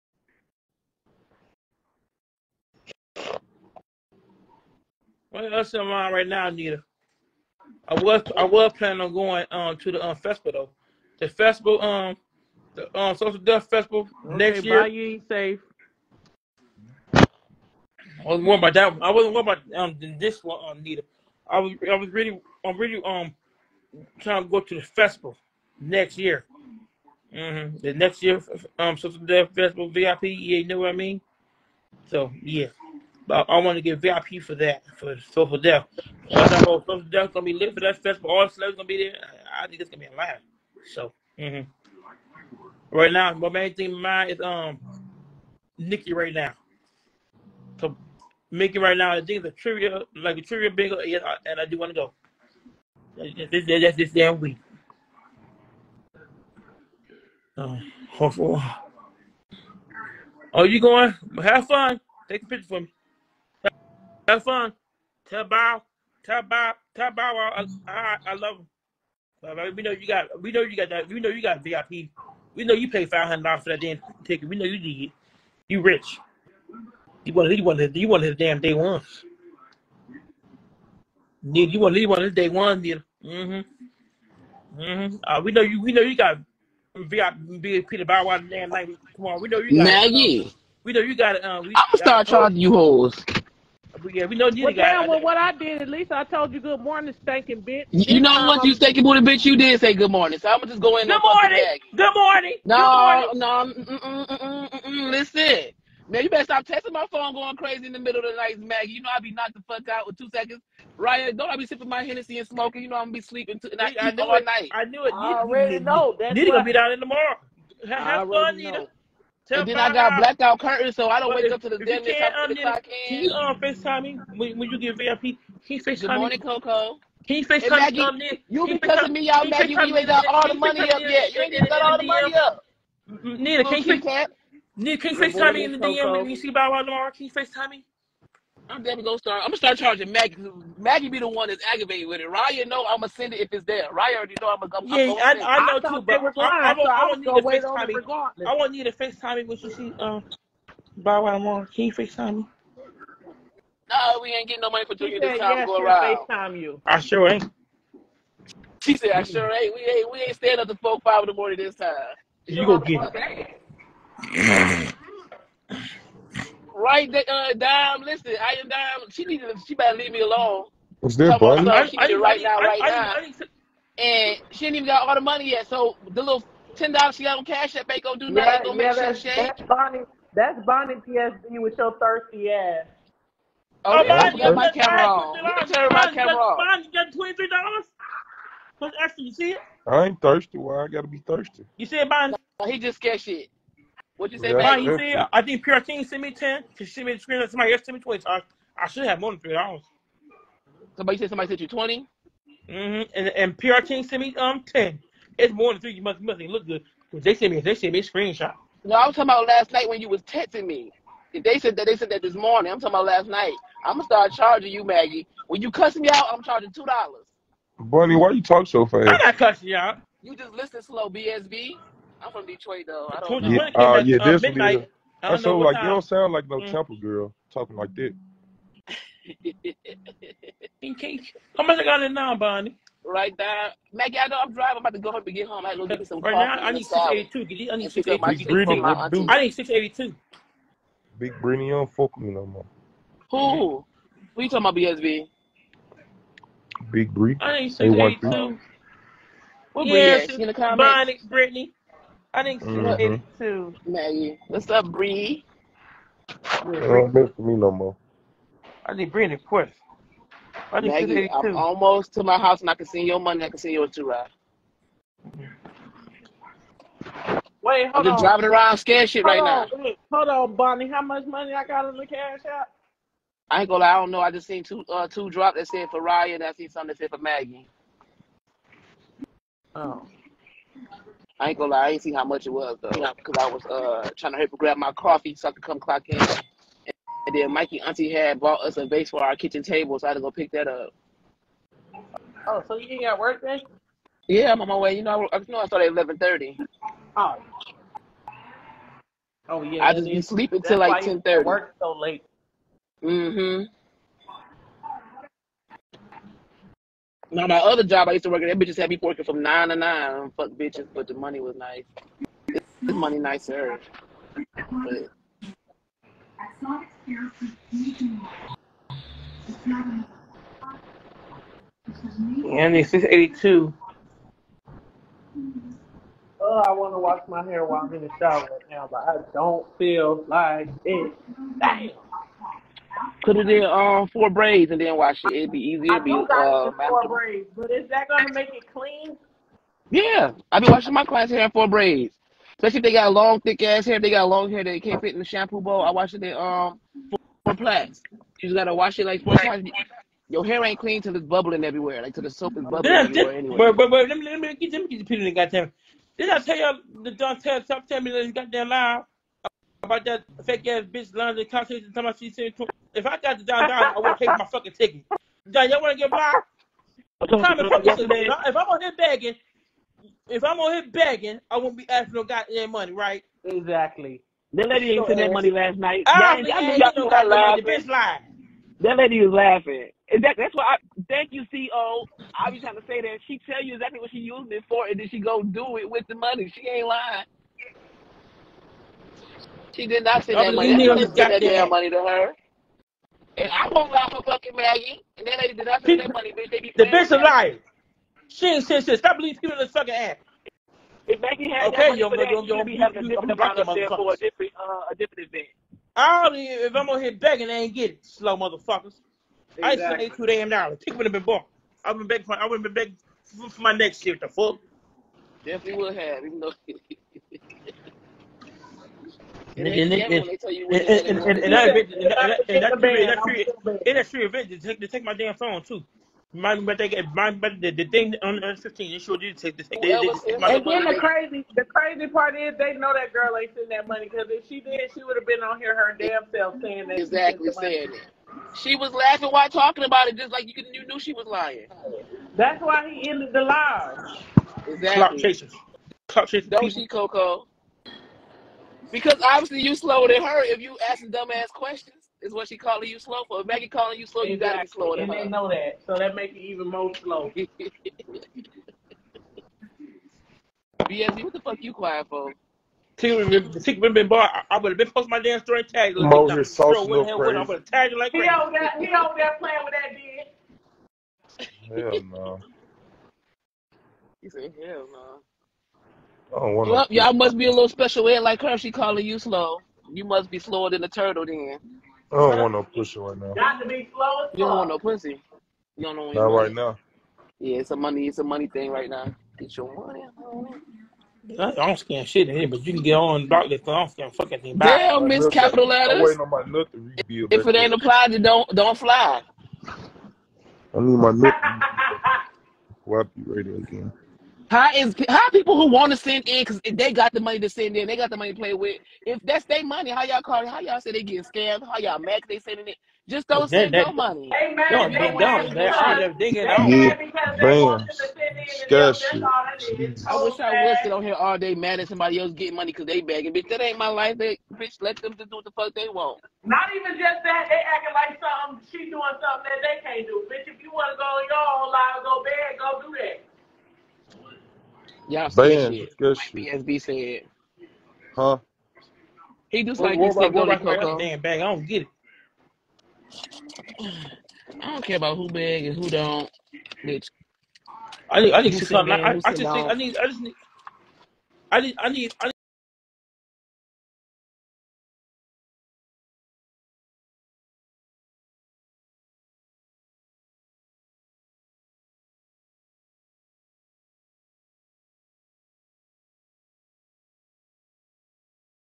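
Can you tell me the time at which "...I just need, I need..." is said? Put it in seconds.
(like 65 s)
549 s.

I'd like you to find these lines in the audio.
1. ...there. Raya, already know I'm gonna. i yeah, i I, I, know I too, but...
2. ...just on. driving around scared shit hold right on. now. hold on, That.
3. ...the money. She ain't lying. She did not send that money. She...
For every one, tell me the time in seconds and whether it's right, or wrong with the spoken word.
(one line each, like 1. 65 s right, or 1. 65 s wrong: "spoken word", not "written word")
1. 143 s right
2. 268 s wrong: "Bonnie", not "That"
3. 386 s right.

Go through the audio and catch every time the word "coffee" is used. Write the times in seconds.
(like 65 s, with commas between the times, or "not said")
284 s.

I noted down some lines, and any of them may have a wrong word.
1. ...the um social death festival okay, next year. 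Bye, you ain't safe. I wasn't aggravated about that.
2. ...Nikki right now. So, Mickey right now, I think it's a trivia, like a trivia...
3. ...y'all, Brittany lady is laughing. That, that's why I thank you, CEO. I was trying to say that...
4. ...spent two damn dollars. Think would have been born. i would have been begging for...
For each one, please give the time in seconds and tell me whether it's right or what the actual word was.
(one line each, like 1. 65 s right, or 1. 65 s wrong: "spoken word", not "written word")
1. 12 s wrong: "worried", not "aggravated"
2. 45 s right
3. 377 s wrong: "That", not "Brittany"
4. 409 s right.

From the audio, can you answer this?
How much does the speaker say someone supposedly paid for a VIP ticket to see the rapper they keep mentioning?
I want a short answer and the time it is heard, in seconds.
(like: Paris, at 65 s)
$500, at 73 s.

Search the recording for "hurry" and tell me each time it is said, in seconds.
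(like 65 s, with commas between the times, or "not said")
284 s.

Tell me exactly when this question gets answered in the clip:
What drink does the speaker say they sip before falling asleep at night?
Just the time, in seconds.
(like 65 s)
112 s.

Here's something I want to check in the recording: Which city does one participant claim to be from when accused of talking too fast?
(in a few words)
Detroit.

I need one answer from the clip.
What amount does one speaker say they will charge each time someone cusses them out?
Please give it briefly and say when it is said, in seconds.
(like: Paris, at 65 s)
$2, at 216 s.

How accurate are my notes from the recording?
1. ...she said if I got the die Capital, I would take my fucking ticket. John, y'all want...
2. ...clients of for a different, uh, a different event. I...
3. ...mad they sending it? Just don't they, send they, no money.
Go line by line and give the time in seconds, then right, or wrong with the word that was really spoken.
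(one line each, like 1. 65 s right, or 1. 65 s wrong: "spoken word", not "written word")
1. 362 s wrong: "Donne", not "Capital"
2. 403 s wrong: "amount", not "clients"
3. 511 s right.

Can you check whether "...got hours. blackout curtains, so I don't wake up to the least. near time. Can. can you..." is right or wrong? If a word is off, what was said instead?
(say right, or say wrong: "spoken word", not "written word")
wrong: "dentist", not "least".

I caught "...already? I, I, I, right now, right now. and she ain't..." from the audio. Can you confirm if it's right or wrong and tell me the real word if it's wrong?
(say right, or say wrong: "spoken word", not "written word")
wrong: "buddy", not "already".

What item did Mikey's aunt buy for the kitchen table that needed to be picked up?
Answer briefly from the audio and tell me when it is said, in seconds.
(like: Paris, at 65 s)
a vase, at 288 s.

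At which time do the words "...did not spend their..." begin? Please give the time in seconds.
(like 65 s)
395 s.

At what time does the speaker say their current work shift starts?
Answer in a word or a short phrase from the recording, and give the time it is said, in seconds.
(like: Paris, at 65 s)
11:30, at 295 s.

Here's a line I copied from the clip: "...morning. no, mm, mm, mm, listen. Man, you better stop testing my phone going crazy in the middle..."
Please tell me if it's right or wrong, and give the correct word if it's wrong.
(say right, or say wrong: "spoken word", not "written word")
right.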